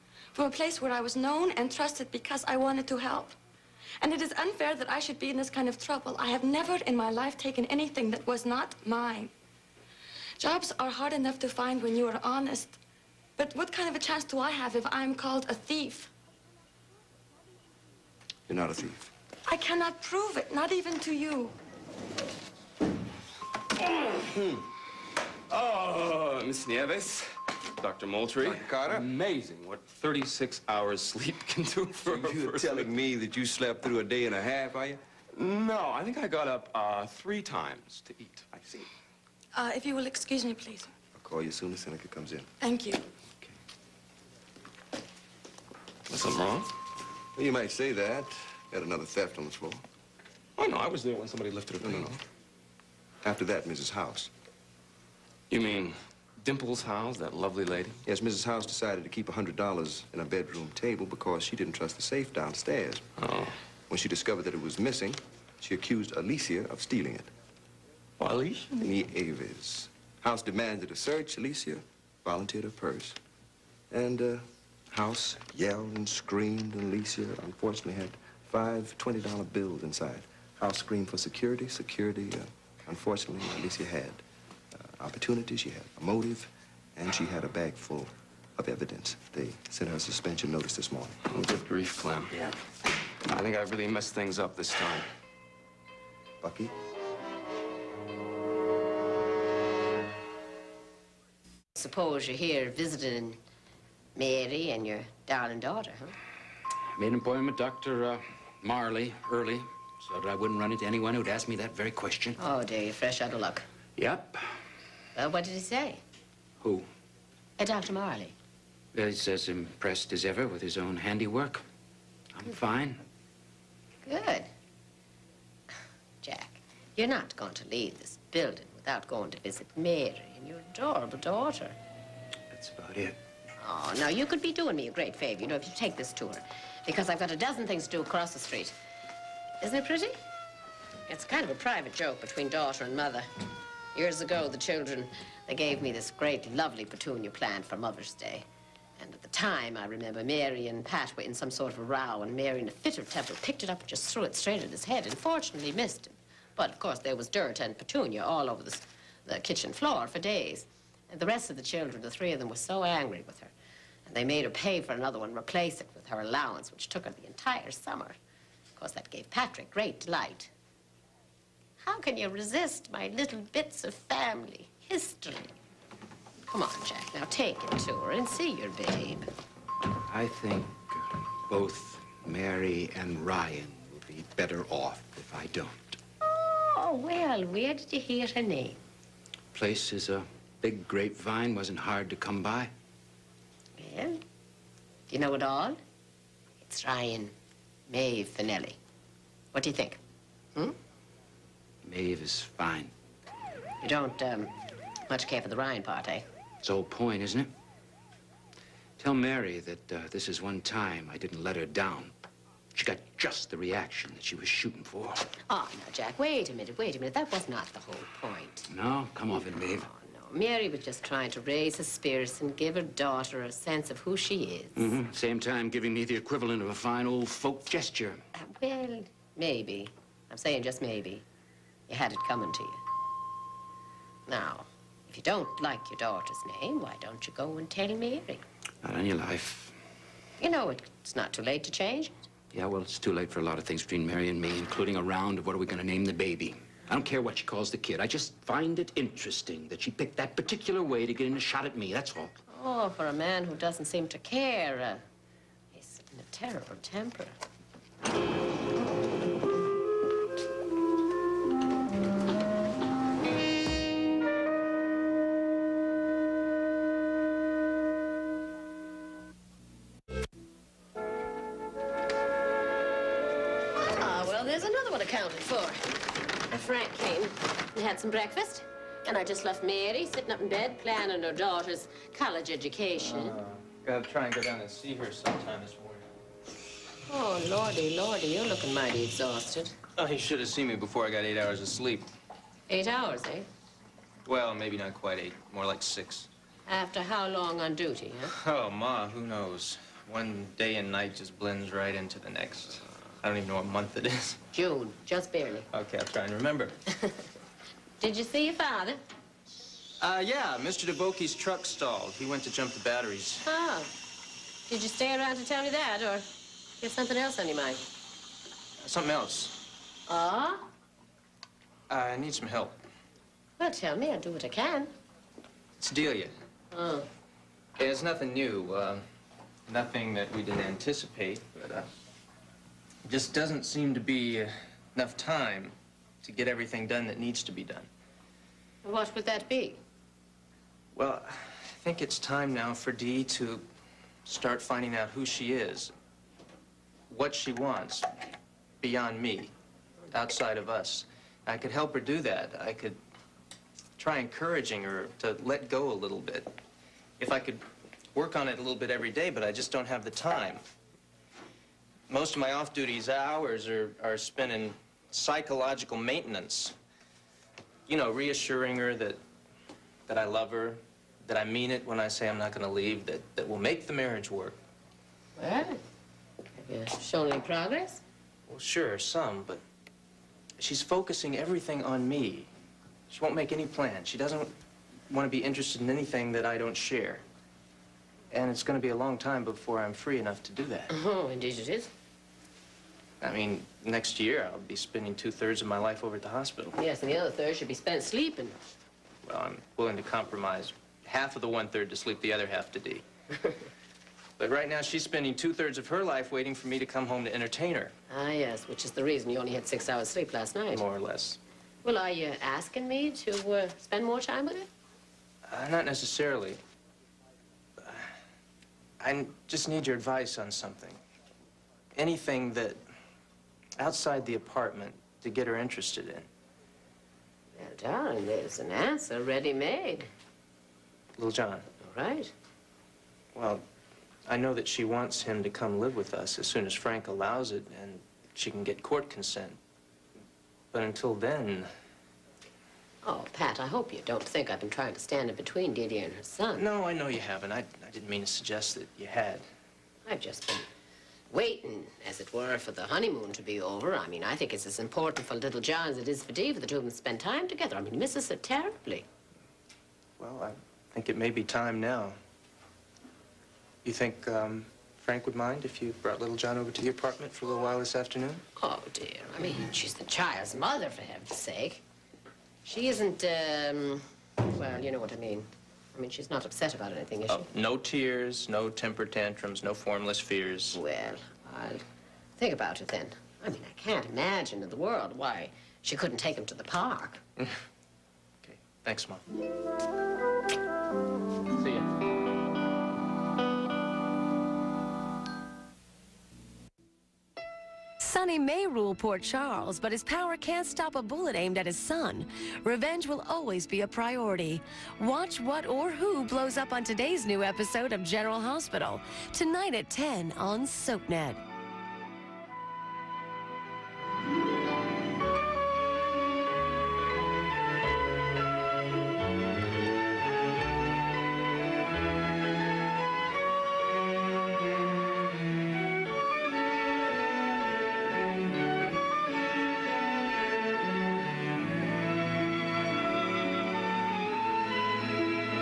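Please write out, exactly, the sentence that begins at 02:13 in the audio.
Oh, now, you could be doing me a great favor, you know, if you take this tour.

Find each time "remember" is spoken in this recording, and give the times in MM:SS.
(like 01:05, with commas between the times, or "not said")
02:29, 05:06.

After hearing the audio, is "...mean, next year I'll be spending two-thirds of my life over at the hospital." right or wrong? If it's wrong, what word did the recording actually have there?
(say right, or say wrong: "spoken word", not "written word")
right.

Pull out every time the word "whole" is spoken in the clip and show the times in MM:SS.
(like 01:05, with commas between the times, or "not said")
03:26, 03:37.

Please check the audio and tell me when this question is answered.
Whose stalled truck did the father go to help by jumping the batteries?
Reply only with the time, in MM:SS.
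05:10.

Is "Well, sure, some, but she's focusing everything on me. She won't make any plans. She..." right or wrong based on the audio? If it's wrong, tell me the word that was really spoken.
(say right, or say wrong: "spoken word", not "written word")
right.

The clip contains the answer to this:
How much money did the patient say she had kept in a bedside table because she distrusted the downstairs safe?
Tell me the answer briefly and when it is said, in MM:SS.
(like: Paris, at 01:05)
$100, at 00:59.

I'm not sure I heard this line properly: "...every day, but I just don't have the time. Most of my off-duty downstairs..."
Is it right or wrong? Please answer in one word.
wrong.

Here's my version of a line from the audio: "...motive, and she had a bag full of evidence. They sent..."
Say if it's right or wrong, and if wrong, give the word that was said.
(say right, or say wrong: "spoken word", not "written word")
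right.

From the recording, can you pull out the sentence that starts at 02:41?
And the rest of the children, the three of them, were so angry with her.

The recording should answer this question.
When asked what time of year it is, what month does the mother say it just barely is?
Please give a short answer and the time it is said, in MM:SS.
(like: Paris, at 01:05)
June, at 05:04.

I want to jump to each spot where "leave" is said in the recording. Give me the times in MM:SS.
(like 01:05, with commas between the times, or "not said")
02:07, 06:12.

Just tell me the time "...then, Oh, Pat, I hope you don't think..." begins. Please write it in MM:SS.
07:21.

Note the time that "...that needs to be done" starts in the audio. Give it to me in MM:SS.
05:37.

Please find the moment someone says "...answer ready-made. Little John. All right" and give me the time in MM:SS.
07:08.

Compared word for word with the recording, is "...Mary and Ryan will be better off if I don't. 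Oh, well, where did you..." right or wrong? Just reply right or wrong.
right.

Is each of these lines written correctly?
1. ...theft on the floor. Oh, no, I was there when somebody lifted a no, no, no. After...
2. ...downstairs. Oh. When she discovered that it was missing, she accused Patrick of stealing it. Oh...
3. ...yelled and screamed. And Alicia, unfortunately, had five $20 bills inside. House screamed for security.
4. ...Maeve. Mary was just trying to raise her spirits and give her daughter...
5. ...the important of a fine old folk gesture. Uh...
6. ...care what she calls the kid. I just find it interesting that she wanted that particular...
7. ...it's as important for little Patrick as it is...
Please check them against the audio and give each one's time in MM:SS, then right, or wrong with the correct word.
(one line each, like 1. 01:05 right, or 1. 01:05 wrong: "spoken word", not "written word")
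1. 00:49 right
2. 01:02 wrong: "Alicia", not "Patrick"
3. 01:15 right
4. 03:39 right
5. 03:46 wrong: "equivalent", not "important"
6. 04:07 wrong: "picked", not "wanted"
7. 07:34 wrong: "John", not "Patrick".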